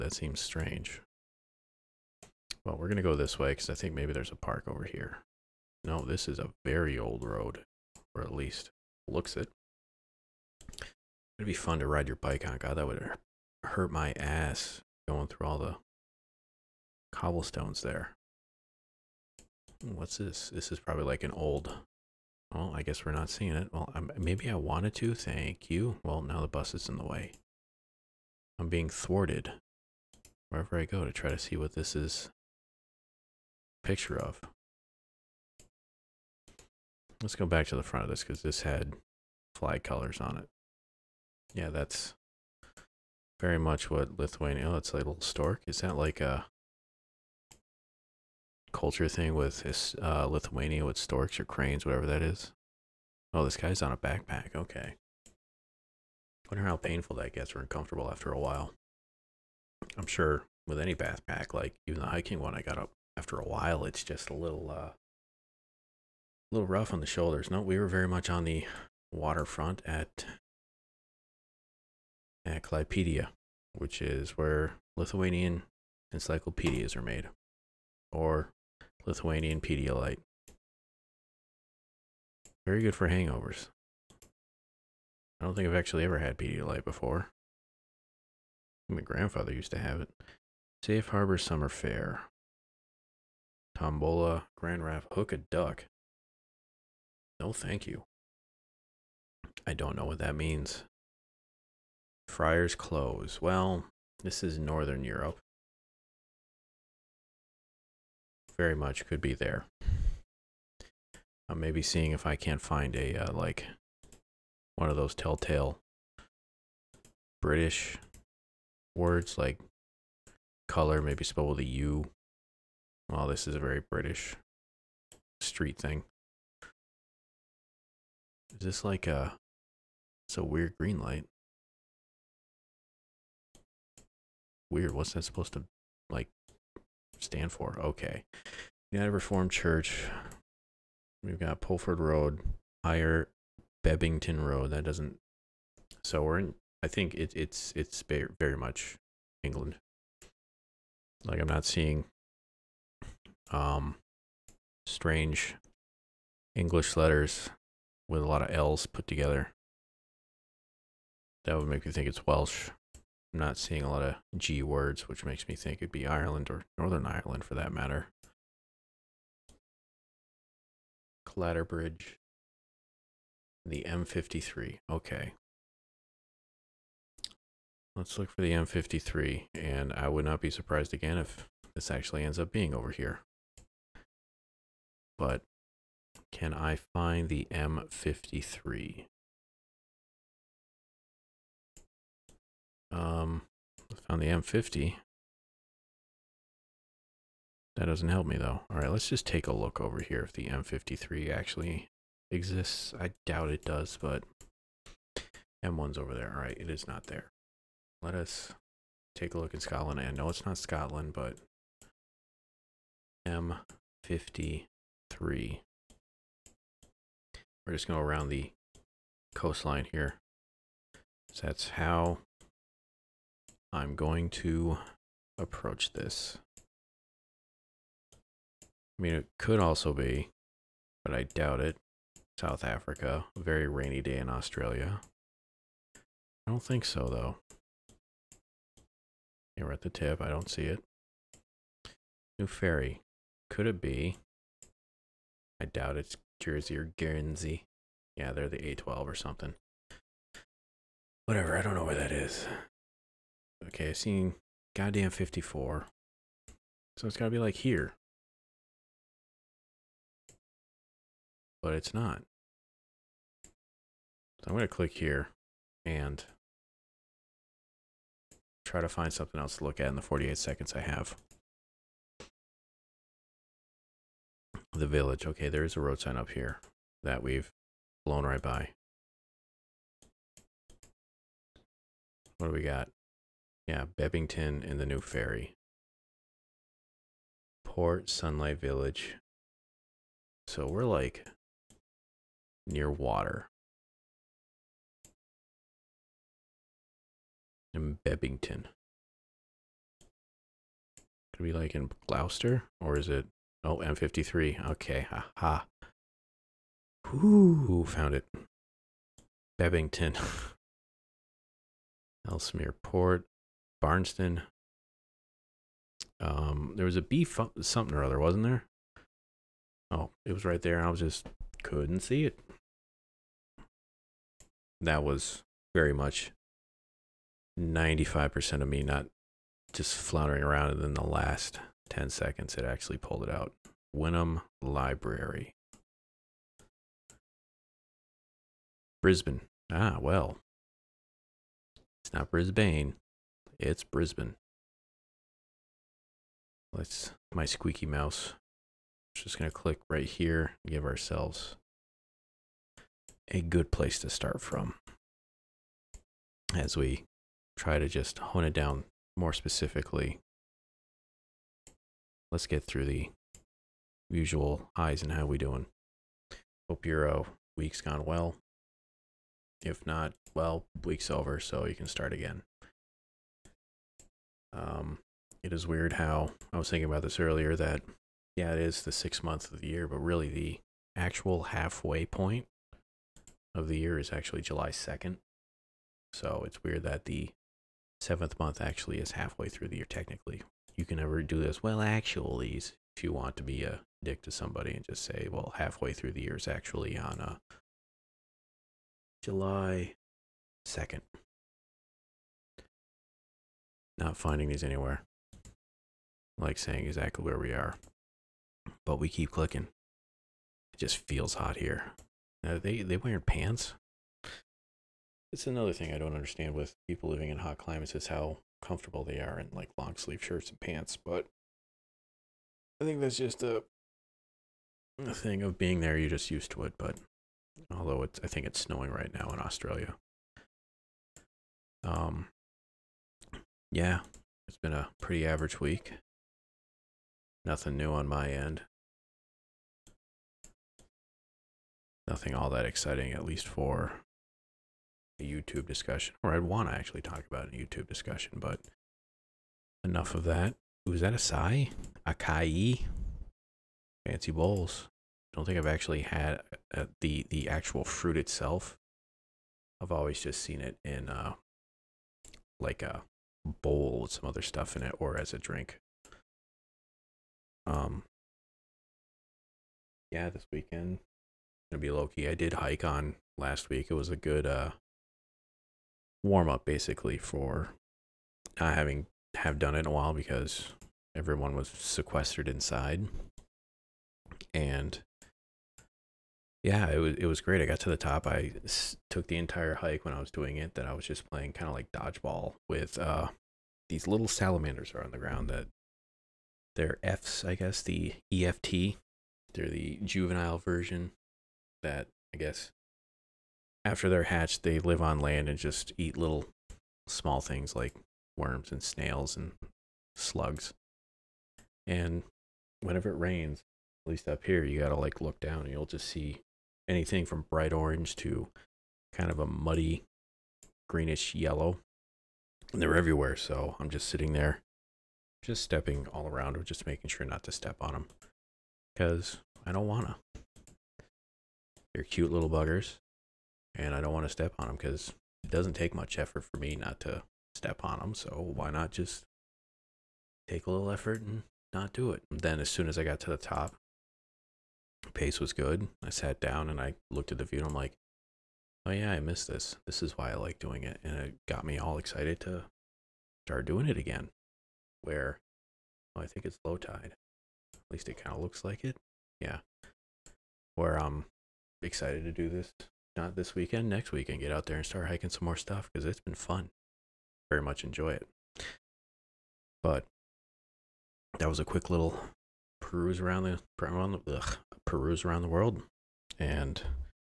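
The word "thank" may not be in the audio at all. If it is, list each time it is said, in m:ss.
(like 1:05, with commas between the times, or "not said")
0:25, 1:37.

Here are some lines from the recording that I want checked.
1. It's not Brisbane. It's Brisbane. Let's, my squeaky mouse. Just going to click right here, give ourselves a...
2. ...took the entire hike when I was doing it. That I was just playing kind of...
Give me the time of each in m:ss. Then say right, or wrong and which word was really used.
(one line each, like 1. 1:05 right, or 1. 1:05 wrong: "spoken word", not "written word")
1. 5:42 right
2. 8:09 right.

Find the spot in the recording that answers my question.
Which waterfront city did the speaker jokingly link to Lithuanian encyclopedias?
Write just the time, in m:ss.
1:12.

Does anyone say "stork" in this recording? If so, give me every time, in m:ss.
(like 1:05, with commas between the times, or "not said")
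0:45, 0:50.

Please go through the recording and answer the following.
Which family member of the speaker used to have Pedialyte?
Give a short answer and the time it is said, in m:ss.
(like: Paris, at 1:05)
Grandfather, at 1:28.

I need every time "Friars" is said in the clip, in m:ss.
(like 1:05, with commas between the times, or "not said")
1:42.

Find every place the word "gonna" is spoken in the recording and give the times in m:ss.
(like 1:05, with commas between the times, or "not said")
4:24, 7:51.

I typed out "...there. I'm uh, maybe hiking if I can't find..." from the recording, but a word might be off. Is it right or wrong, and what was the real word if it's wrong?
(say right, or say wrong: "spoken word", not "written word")
wrong: "seeing", not "hiking".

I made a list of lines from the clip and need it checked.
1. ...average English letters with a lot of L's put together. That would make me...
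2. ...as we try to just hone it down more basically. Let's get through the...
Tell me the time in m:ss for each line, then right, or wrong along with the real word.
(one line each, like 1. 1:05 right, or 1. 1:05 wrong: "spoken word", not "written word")
1. 2:34 wrong: "strange", not "average"
2. 5:56 wrong: "specifically", not "basically".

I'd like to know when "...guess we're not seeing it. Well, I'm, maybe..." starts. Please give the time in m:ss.
0:22.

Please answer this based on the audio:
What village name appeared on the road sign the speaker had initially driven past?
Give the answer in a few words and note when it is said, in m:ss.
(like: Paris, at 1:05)
Port Sunlight Village, at 4:47.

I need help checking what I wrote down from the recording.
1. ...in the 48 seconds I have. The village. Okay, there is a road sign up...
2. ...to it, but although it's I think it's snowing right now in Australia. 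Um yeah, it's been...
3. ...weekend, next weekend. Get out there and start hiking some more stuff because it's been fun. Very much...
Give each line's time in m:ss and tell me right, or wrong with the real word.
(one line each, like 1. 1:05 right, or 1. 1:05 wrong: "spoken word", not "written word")
1. 4:29 right
2. 7:06 right
3. 9:23 right.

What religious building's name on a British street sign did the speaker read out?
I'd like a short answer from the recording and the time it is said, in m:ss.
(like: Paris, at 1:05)
United Reformed Church, at 2:18.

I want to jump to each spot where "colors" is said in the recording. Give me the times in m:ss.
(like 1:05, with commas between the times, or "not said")
0:39, 2:00.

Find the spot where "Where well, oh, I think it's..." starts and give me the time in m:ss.
9:15.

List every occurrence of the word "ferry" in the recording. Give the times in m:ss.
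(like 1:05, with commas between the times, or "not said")
4:02, 4:45.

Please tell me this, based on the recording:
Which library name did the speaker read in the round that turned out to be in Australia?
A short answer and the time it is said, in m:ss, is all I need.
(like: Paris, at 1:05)
Wynnum Library, at 5:33.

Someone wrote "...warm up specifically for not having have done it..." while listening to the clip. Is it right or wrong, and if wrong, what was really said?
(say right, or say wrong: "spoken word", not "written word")
wrong: "basically", not "specifically".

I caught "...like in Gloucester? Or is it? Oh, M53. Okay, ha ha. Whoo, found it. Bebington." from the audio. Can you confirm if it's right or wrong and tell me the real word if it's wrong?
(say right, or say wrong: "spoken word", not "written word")
right.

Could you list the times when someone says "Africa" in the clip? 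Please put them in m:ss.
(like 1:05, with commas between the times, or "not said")
3:52.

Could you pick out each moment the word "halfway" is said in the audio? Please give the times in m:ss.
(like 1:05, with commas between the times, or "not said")
6:21, 6:29, 6:35.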